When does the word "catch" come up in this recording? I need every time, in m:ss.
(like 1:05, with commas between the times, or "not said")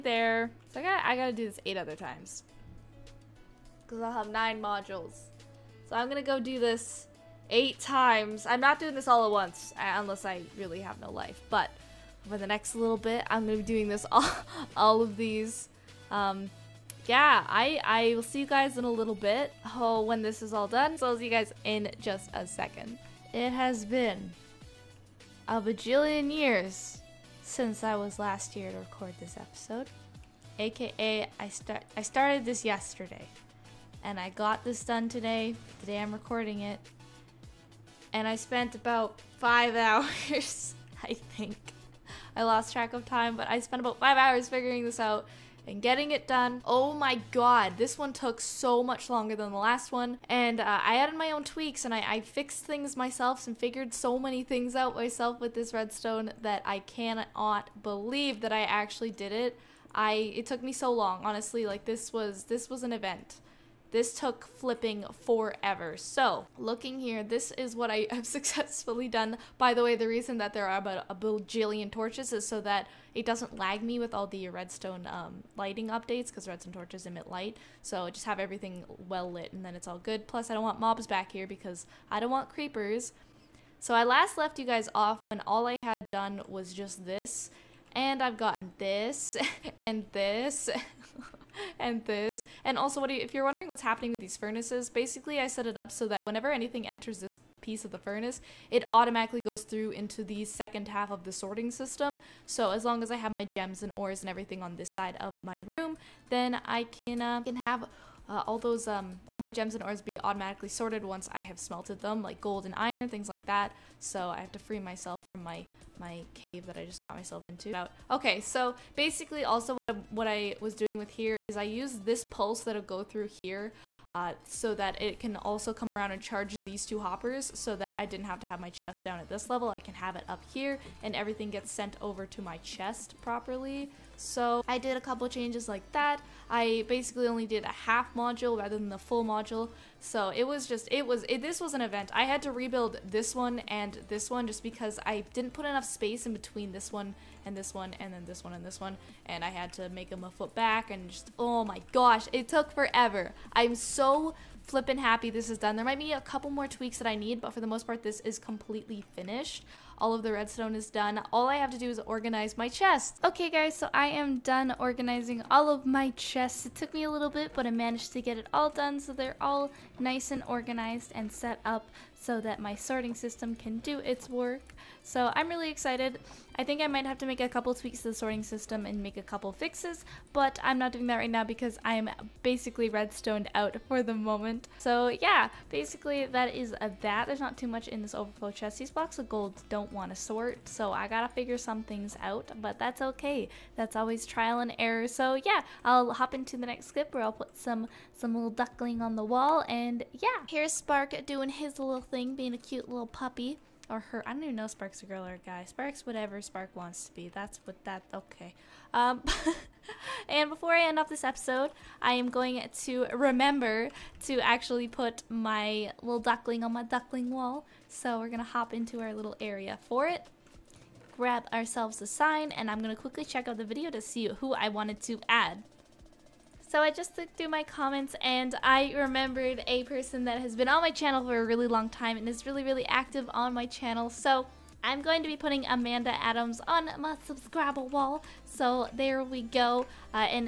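not said.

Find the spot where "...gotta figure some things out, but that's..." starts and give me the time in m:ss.
3:11.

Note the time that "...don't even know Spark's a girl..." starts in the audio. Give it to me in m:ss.
3:24.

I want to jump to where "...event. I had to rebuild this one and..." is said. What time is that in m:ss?
2:21.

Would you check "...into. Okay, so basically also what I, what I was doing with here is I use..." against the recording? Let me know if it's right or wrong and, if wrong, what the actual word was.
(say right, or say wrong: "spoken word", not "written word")
right.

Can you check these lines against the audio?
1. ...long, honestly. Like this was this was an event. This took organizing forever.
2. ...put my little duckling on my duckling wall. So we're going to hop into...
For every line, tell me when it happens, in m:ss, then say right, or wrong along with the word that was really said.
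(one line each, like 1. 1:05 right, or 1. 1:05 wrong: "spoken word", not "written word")
1. 1:00 wrong: "flipping", not "organizing"
2. 3:34 right.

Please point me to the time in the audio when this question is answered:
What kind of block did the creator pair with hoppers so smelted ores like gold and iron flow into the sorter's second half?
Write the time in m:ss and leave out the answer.
1:34.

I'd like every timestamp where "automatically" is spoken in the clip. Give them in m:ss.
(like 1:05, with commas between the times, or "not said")
1:38, 1:50.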